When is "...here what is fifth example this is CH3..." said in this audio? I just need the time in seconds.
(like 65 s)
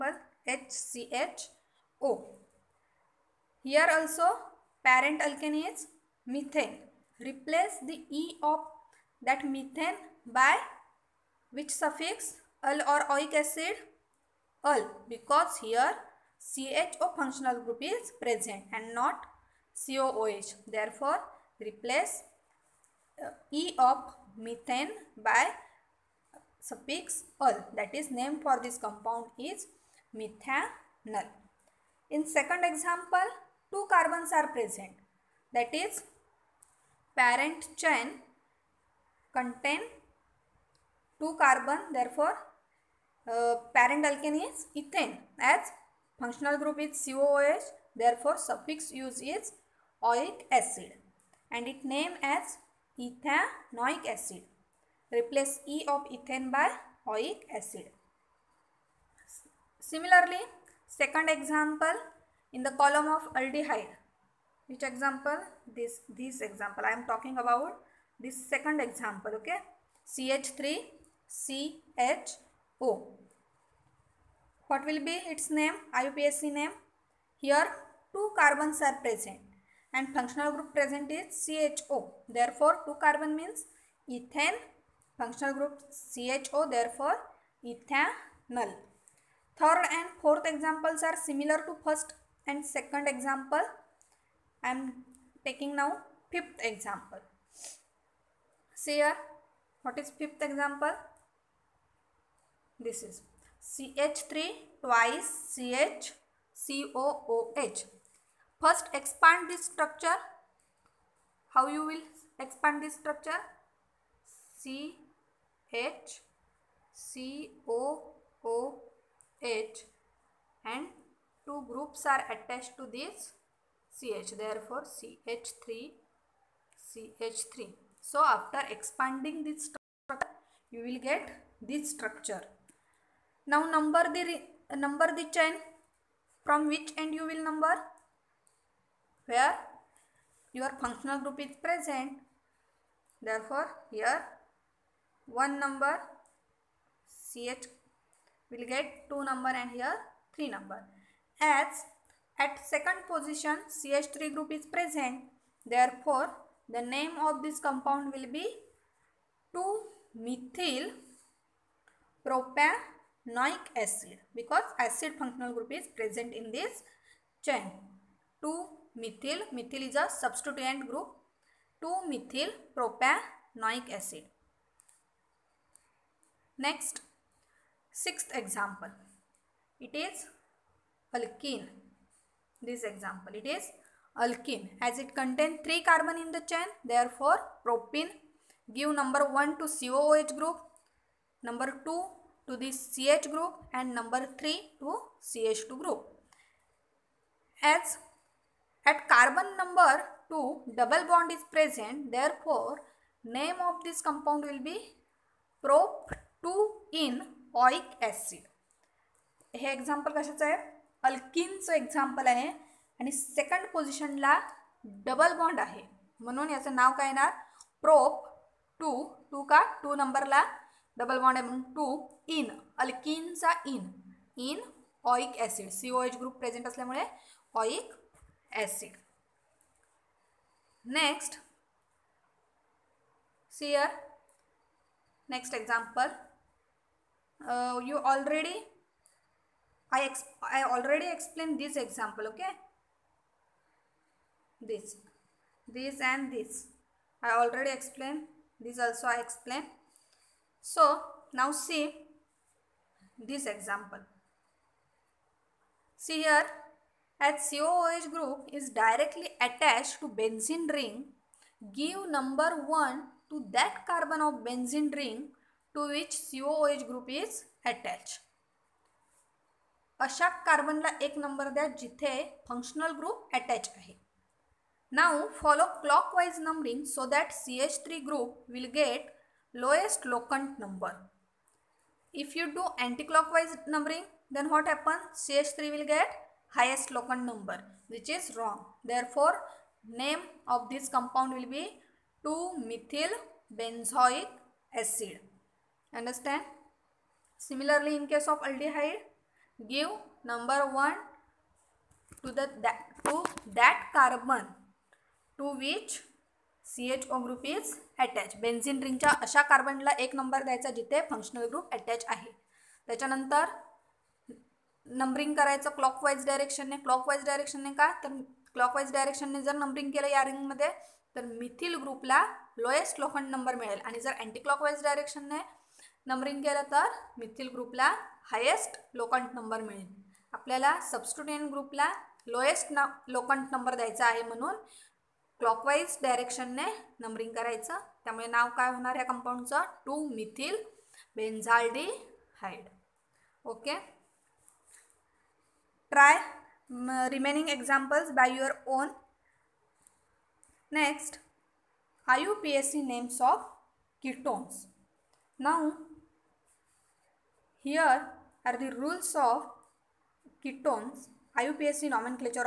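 99 s.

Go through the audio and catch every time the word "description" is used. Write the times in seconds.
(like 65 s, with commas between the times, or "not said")
not said.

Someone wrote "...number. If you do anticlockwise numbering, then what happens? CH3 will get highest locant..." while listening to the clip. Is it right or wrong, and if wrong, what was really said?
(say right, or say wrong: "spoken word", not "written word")
right.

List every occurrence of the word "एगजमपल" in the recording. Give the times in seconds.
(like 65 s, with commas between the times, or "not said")
235 s.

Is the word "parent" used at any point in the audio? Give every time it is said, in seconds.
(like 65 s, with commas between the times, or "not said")
4 s, 37 s, 43 s.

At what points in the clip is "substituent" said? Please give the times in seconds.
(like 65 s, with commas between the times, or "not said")
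170 s.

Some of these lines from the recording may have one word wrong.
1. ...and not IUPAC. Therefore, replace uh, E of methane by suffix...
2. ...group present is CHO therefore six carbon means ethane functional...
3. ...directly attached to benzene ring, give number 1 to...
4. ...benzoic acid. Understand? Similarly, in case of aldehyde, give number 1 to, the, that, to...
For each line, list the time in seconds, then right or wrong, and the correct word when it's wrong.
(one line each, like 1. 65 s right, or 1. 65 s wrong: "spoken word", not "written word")
1. 18 s wrong: "COOH", not "IUPAC"
2. 80 s wrong: "two", not "six"
3. 258 s right
4. 293 s right.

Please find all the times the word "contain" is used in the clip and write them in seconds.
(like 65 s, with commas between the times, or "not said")
39 s, 185 s.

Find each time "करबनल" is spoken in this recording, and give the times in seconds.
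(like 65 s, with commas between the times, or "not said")
270 s, 309 s.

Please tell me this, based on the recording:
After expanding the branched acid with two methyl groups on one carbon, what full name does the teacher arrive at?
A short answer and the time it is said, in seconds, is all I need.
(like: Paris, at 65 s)
2-methyl propanoic acid, at 171 s.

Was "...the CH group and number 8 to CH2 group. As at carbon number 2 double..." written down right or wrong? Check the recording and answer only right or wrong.
wrong.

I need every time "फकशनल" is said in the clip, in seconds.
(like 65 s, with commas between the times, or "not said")
272 s, 311 s.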